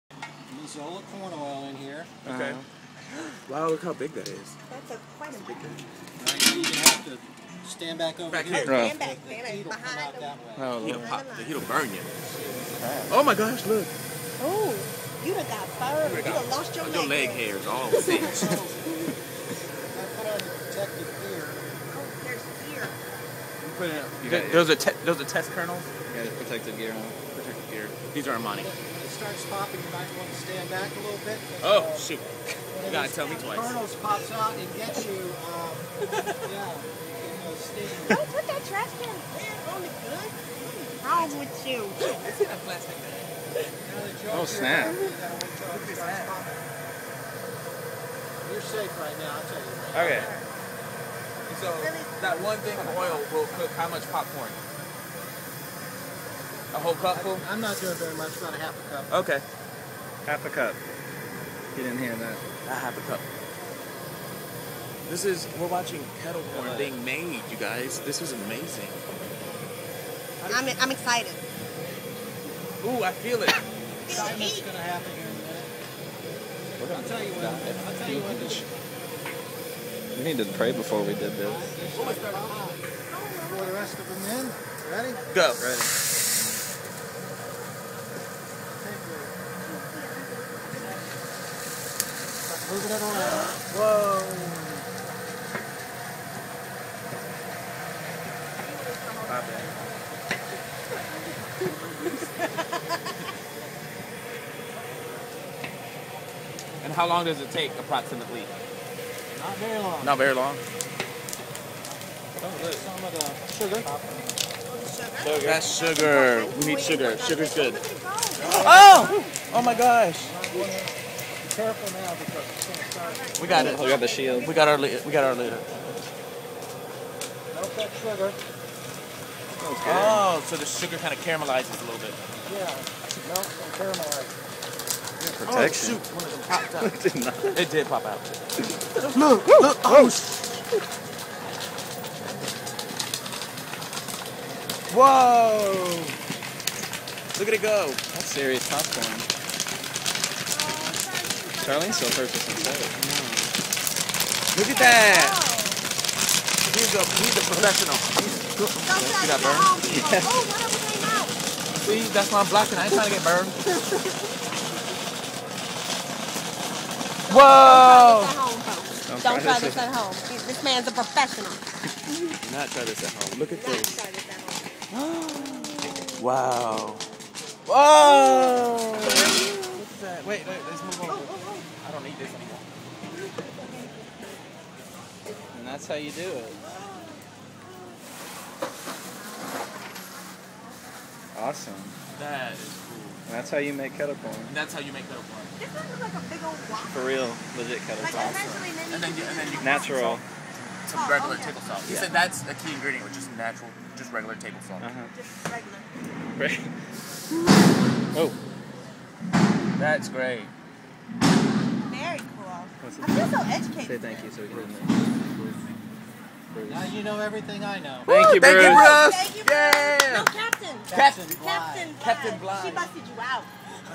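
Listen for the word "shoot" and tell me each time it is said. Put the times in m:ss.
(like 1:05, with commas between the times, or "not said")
0:31, 2:15.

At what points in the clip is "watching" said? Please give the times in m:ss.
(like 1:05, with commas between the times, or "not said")
1:05.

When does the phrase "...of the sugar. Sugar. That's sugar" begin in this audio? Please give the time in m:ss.
1:53.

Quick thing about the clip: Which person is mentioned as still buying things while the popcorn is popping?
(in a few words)
Charlene.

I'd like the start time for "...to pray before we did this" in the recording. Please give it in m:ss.
1:20.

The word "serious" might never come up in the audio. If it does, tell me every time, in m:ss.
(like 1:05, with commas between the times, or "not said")
2:28.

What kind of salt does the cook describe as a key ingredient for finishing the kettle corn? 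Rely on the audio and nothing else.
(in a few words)
regular table salt.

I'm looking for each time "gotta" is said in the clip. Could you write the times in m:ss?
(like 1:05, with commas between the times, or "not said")
0:32.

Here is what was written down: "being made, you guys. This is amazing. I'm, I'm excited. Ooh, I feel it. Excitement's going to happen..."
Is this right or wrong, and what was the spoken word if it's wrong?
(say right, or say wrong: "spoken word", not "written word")
right.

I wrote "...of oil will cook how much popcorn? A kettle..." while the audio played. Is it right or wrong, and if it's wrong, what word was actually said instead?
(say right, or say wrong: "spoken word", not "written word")
wrong: "whole", not "kettle".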